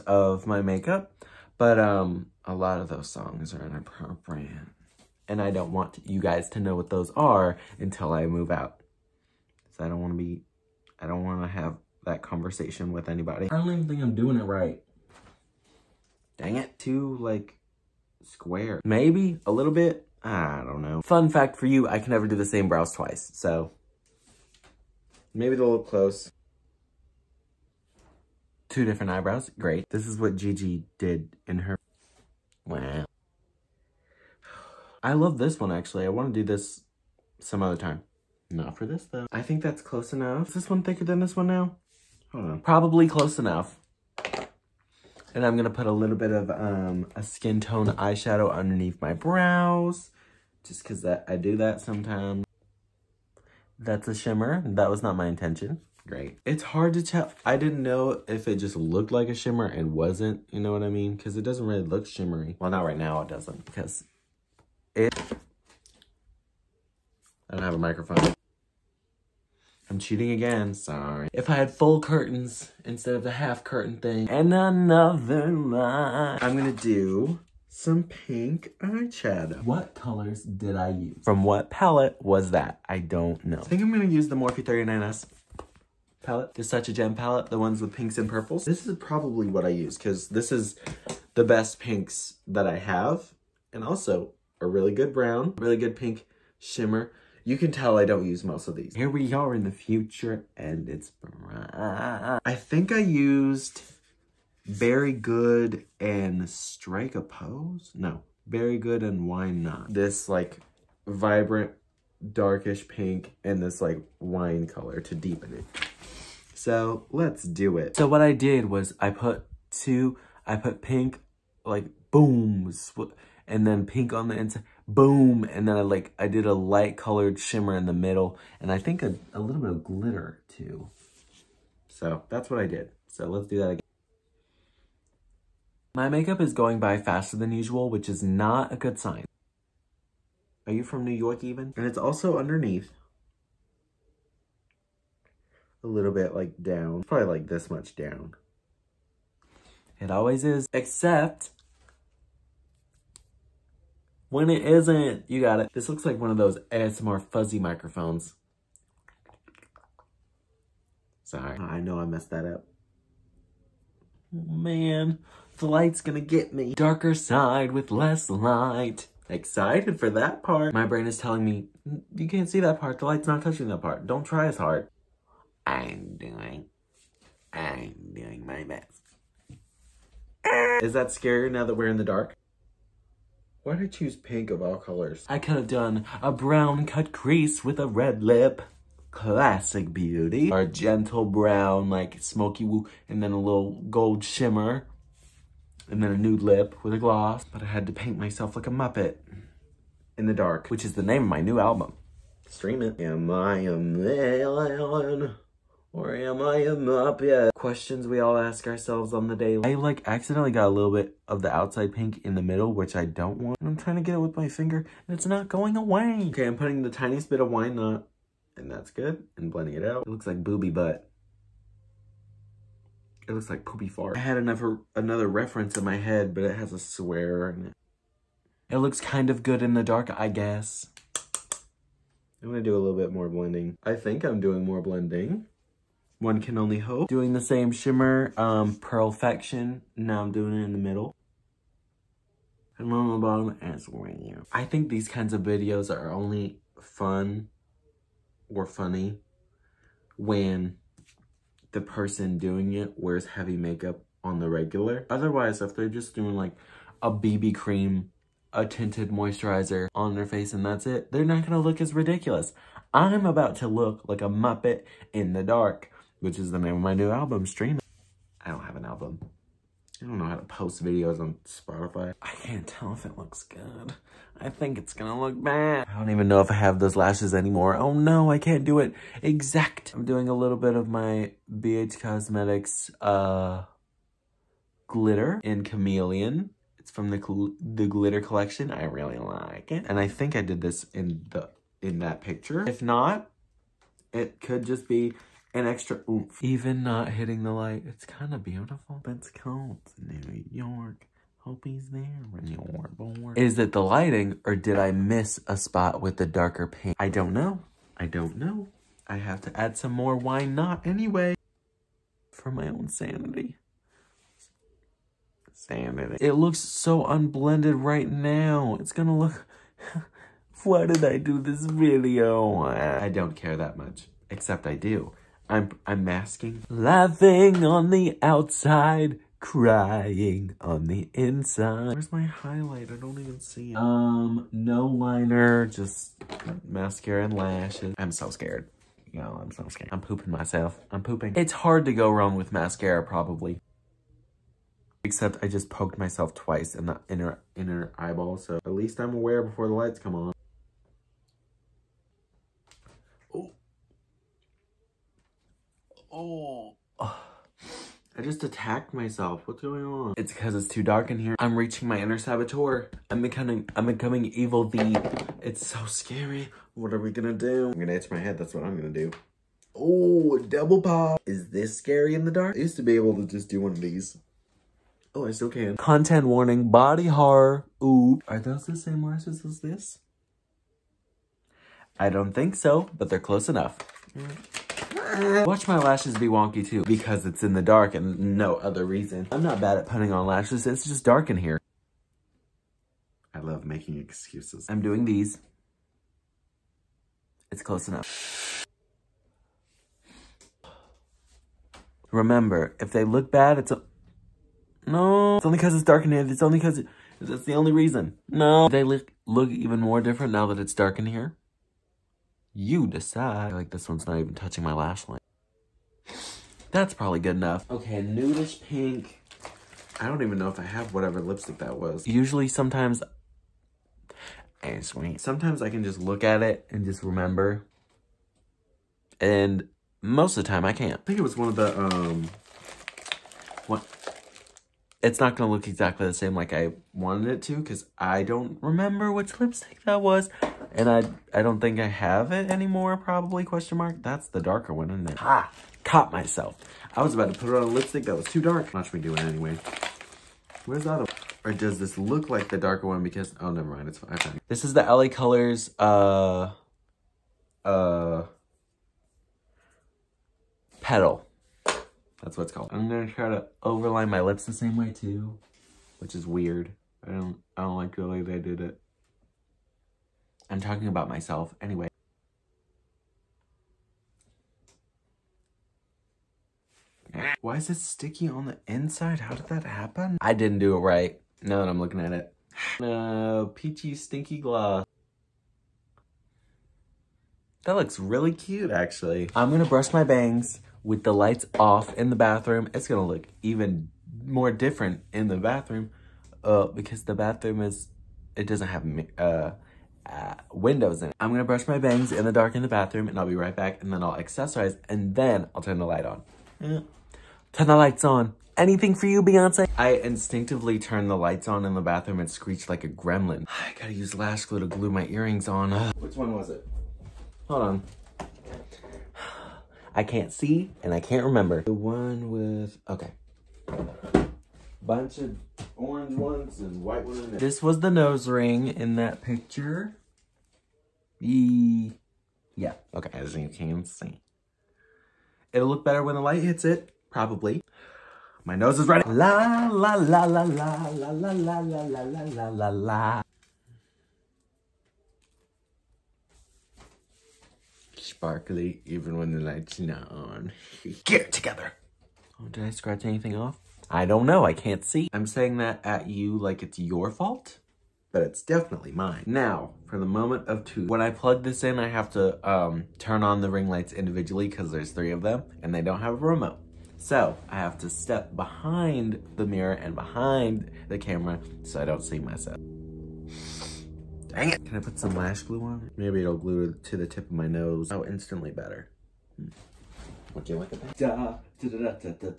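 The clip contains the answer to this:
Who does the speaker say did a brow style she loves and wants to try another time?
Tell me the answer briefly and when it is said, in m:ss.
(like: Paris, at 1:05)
Gigi, at 0:30.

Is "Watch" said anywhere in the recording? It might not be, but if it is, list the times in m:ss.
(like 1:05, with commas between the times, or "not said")
6:25, 7:28.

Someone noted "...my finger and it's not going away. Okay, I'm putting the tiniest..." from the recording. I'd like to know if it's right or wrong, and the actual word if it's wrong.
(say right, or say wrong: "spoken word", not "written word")
right.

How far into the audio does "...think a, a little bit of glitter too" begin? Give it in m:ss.
2:08.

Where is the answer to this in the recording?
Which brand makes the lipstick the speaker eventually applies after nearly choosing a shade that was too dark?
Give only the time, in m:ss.
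7:34.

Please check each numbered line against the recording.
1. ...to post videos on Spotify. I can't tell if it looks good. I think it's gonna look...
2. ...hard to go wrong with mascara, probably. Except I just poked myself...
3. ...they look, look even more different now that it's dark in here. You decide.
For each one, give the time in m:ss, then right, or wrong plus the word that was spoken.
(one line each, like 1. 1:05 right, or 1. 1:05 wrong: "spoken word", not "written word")
1. 4:30 right
2. 5:41 right
3. 6:48 right.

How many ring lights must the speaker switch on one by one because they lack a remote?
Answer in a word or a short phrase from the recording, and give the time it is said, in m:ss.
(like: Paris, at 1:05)
3, at 9:24.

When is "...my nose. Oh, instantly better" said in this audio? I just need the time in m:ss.
9:37.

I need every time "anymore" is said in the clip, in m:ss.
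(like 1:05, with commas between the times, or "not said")
4:37, 7:22.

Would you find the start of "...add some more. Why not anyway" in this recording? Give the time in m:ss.
5:09.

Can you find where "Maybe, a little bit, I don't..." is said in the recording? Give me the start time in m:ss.
0:18.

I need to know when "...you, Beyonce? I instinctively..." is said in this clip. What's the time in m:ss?
8:29.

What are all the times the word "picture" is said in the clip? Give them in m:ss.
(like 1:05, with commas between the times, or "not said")
4:52, 8:49.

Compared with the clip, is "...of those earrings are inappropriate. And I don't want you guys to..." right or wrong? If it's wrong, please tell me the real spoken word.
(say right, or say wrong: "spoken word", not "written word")
wrong: "songs", not "earrings".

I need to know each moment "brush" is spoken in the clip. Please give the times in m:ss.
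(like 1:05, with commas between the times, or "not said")
8:09, 8:21.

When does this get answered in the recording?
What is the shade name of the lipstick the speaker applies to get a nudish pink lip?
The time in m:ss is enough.
7:40.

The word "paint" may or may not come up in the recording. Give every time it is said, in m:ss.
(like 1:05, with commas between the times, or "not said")
3:17, 5:06.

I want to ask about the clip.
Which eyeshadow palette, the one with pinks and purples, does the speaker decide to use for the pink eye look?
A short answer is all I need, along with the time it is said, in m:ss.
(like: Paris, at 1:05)
Morphe 39S, at 1:24.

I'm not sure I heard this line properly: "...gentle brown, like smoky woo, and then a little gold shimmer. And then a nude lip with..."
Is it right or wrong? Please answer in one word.
right.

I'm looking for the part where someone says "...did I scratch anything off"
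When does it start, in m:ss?
9:12.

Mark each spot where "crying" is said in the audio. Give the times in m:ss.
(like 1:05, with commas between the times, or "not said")
5:29.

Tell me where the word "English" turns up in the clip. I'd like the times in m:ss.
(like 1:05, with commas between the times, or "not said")
not said.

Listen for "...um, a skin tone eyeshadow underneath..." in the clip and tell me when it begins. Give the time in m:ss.
0:46.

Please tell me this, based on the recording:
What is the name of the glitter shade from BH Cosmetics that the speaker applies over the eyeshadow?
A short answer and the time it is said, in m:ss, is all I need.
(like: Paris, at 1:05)
Chameleon, at 4:45.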